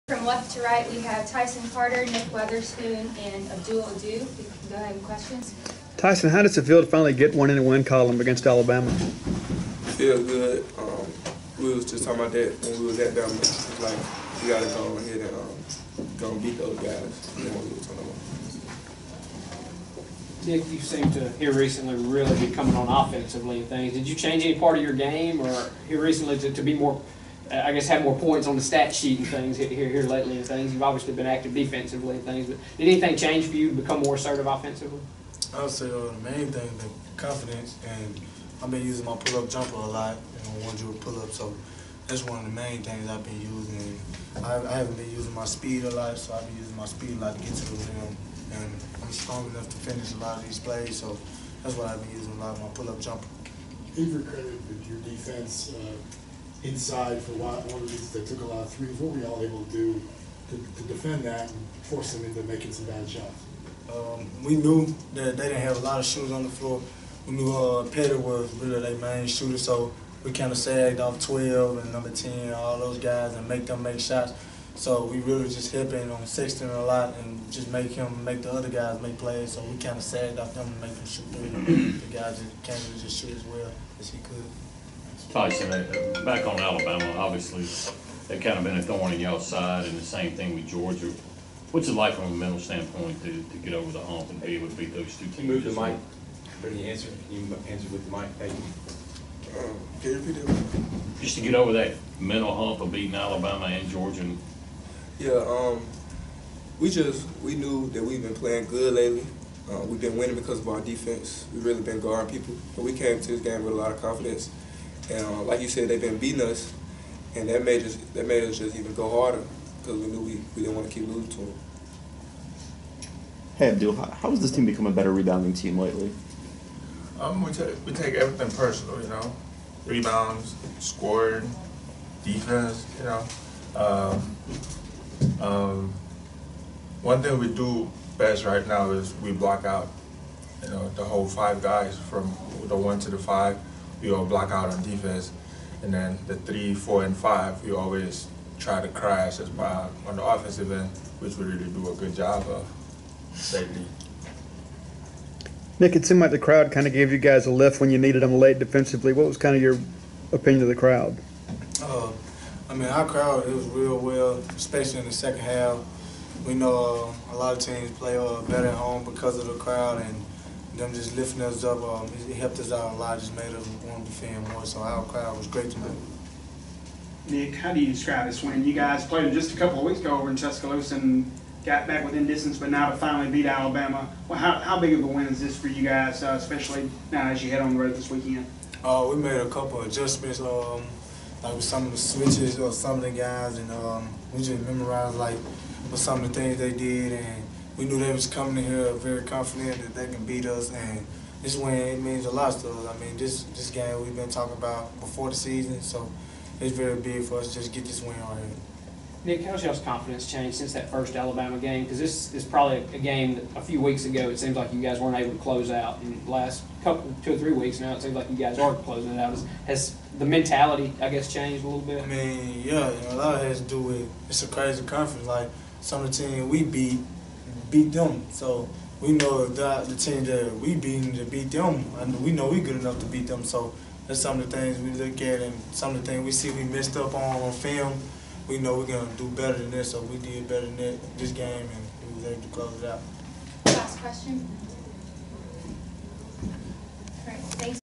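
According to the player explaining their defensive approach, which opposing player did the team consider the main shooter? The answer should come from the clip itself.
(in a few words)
Petty.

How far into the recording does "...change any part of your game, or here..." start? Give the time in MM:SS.
00:24.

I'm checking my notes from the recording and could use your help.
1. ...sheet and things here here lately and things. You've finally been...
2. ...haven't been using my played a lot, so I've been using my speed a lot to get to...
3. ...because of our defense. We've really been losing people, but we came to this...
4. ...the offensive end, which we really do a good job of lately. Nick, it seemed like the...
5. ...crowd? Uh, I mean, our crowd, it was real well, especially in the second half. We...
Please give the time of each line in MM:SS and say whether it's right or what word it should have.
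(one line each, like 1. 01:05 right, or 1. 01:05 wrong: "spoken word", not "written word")
1. 00:28 wrong: "obviously", not "finally"
2. 00:44 wrong: "speed", not "played"
3. 01:50 wrong: "guarding", not "losing"
4. 02:30 right
5. 02:40 right.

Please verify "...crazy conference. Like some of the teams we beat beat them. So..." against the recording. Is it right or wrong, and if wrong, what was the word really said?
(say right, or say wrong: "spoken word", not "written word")
right.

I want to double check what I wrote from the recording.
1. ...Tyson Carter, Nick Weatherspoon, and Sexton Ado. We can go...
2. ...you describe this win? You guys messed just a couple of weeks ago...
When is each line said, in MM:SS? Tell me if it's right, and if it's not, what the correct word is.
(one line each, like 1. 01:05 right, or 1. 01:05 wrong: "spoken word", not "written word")
1. 00:01 wrong: "Abdul", not "Sexton"
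2. 02:57 wrong: "played", not "messed".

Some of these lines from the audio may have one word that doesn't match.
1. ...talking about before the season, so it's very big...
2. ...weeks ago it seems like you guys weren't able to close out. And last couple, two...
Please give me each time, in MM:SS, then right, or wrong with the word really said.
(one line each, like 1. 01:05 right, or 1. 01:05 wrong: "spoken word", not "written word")
1. 03:24 right
2. 03:33 right.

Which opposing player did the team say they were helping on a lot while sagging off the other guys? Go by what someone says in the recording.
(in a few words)
Sexton.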